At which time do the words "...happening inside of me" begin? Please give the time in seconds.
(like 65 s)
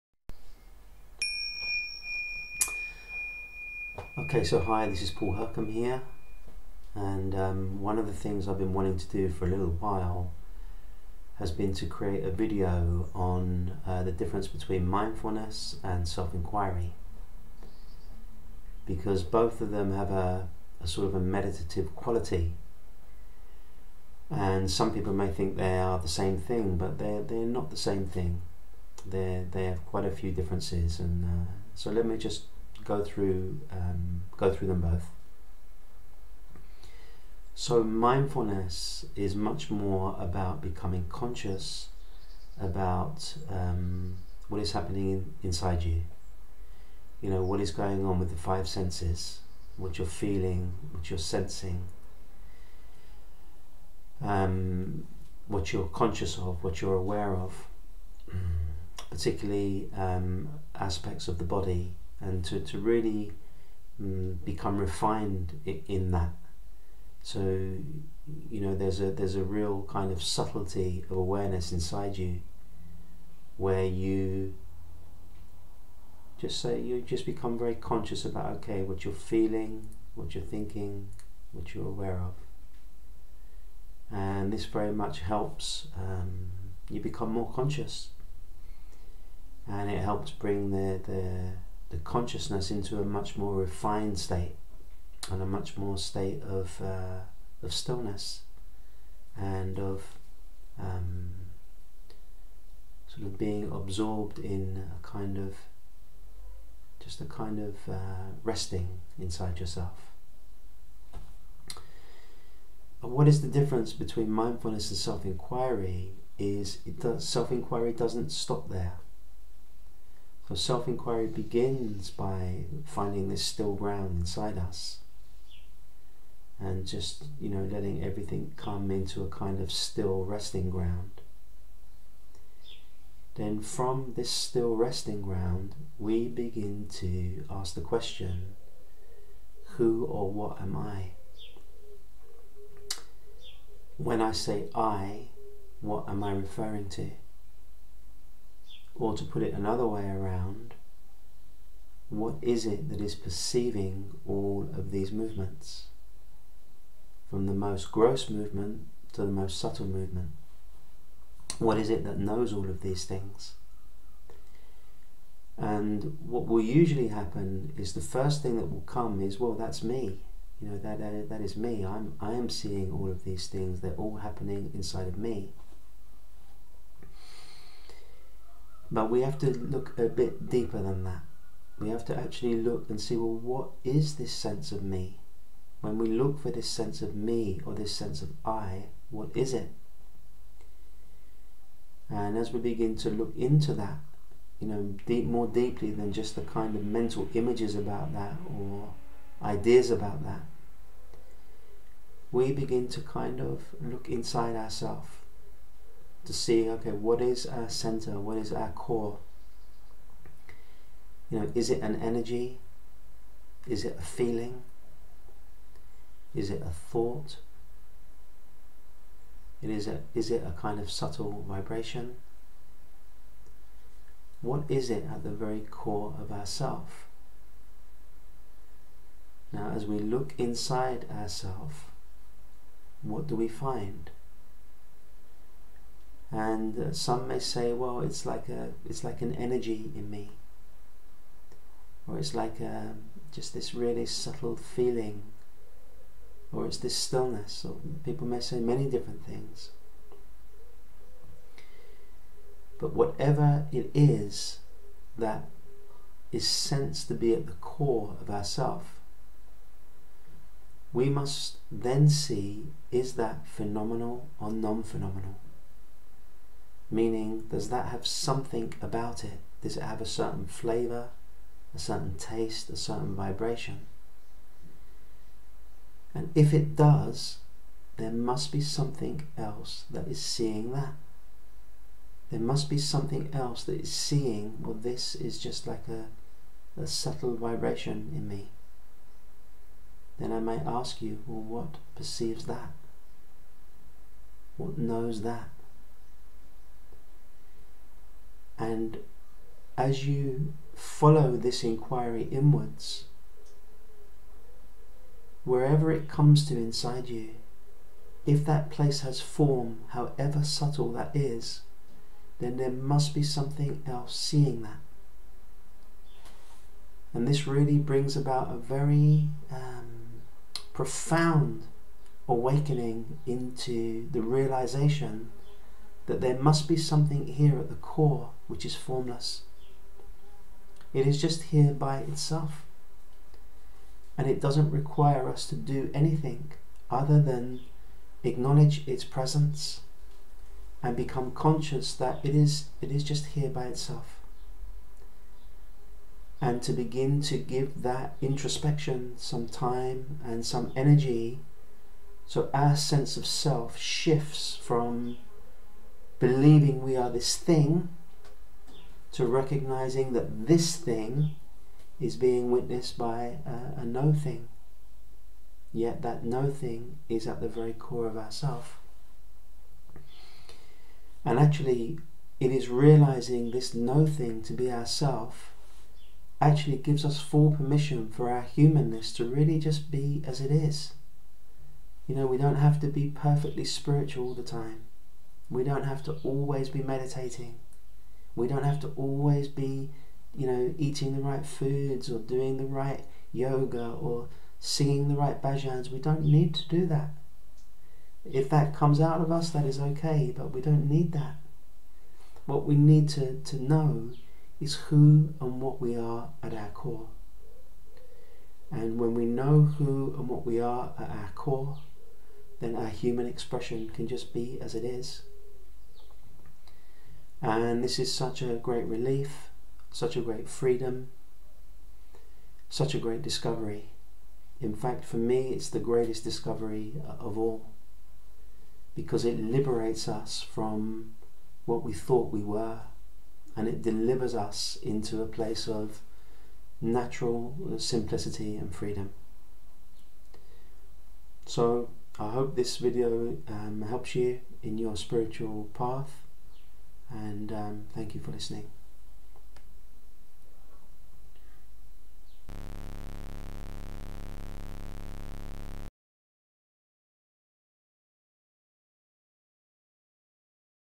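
174 s.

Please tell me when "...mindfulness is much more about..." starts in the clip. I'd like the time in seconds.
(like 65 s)
37 s.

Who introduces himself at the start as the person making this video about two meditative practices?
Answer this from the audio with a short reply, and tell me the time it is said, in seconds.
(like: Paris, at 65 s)
Paul Huckham, at 5 s.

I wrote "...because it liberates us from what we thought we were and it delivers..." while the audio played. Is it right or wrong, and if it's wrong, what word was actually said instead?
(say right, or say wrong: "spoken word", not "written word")
right.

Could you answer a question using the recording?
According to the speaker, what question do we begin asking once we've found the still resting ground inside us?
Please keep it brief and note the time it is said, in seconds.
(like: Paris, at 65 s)
Who or what am I?, at 139 s.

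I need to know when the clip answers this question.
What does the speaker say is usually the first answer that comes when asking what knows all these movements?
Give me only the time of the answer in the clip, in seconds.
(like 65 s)
169 s.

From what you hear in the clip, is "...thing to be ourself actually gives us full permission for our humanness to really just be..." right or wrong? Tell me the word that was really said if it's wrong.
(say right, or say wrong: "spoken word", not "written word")
right.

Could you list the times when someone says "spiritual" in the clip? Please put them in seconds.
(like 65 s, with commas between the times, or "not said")
383 s, 444 s.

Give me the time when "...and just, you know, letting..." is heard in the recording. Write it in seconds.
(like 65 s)
126 s.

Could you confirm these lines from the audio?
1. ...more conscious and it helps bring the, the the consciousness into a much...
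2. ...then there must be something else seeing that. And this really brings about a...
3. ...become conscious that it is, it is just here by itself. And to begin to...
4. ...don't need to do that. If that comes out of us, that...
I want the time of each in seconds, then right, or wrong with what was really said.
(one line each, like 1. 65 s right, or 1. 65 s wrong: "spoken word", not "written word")
1. 87 s right
2. 312 s right
3. 340 s right
4. 395 s right.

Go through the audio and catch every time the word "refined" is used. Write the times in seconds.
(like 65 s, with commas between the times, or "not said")
64 s, 93 s.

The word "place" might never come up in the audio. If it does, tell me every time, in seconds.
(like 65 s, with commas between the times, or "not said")
308 s, 435 s.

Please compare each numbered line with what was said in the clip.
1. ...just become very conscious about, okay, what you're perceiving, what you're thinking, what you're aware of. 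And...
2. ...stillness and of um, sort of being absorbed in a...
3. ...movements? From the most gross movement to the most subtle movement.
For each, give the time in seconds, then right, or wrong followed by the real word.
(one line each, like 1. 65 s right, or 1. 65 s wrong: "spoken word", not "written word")
1. 77 s wrong: "feeling", not "perceiving"
2. 97 s right
3. 155 s right.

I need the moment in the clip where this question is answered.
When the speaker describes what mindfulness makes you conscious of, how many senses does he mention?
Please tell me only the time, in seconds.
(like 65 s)
48 s.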